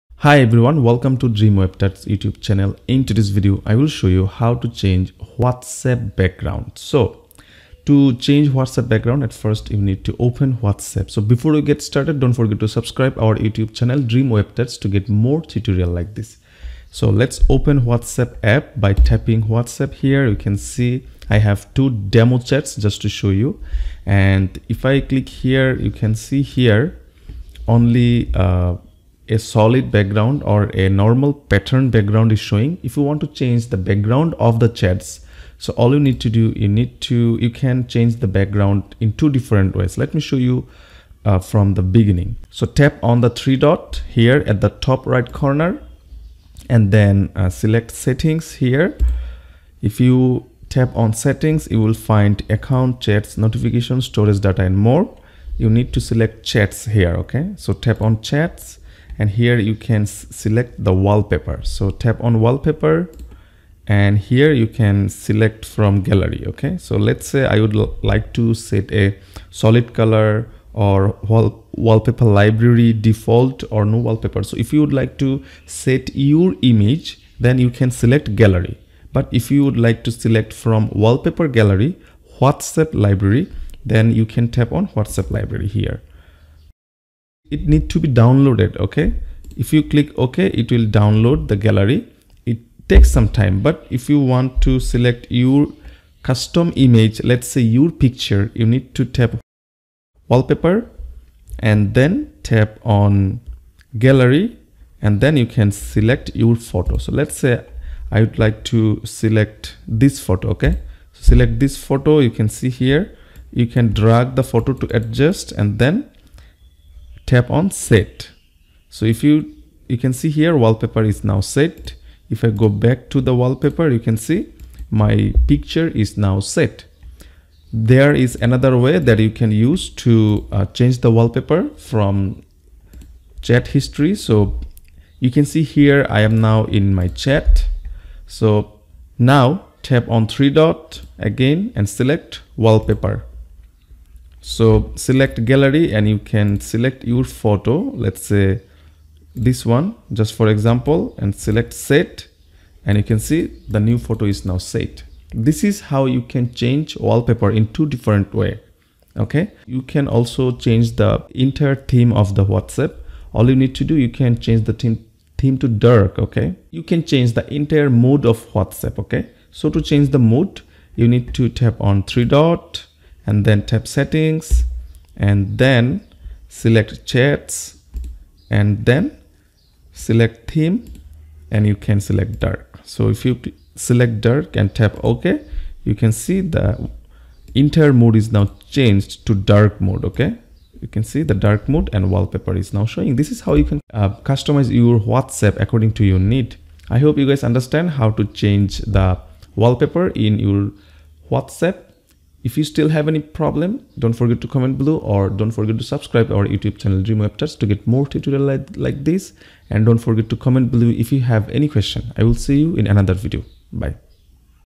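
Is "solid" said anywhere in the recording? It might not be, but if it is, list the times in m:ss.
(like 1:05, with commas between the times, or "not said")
0:29, 1:09.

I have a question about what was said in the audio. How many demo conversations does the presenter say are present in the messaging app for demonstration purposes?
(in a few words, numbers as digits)
2.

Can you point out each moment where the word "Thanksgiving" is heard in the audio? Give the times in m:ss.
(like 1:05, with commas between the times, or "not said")
not said.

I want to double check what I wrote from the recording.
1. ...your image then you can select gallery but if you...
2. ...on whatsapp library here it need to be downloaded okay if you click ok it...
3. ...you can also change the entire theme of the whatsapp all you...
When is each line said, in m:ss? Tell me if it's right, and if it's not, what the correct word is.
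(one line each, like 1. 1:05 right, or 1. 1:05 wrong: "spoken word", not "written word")
1. 1:16 right
2. 1:24 right
3. 2:39 right.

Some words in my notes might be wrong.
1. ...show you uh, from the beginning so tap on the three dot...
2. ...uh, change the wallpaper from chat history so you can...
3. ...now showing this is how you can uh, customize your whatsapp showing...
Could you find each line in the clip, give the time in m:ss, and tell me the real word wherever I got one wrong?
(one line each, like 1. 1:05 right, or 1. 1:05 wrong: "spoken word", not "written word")
1. 0:40 right
2. 2:10 right
3. 3:12 wrong: "according", not "showing".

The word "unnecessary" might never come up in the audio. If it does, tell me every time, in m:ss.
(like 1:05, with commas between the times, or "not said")
not said.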